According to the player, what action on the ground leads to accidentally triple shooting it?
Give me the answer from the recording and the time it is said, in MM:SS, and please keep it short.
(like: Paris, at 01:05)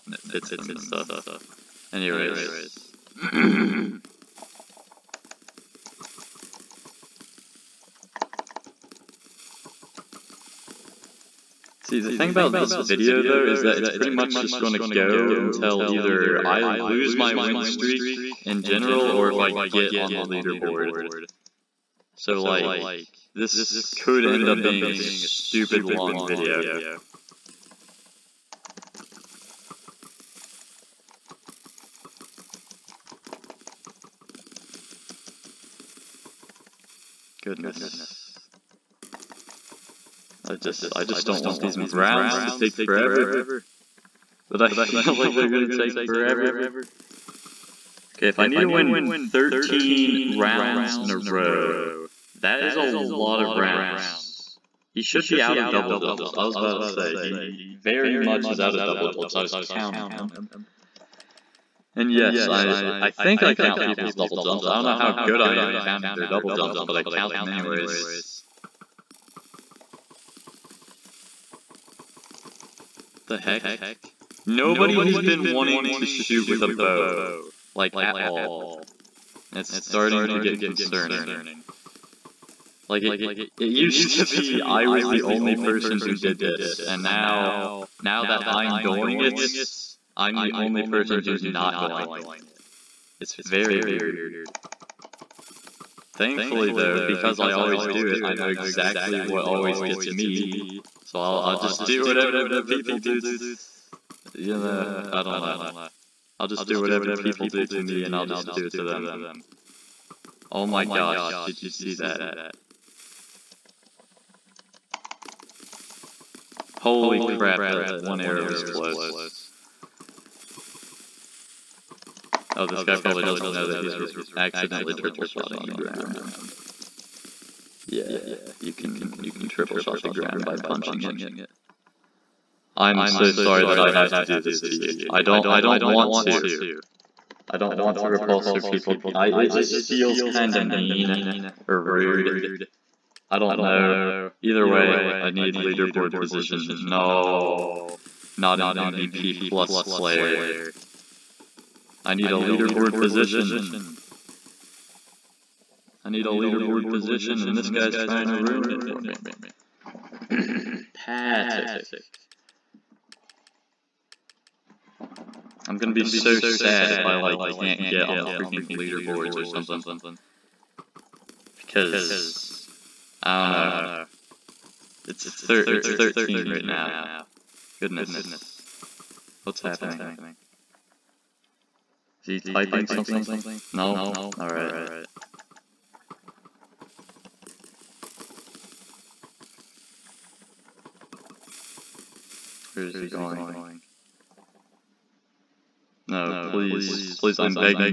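punching, at 02:10.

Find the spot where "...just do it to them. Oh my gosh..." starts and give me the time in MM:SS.
01:48.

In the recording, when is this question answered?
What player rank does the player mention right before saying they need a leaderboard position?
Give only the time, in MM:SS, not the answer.
02:28.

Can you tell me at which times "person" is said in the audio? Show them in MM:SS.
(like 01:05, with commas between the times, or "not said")
01:25, 01:30.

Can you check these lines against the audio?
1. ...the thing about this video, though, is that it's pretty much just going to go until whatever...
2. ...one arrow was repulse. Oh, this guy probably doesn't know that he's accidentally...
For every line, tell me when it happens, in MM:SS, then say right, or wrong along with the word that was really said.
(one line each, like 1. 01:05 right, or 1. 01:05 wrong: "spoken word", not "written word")
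1. 00:12 wrong: "either", not "whatever"
2. 01:57 wrong: "close", not "repulse".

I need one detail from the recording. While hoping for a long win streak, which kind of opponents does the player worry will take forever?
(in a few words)
browns.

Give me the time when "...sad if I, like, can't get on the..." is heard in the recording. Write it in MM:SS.
02:46.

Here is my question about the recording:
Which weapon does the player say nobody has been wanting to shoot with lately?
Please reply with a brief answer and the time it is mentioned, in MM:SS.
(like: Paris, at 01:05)
bow, at 01:16.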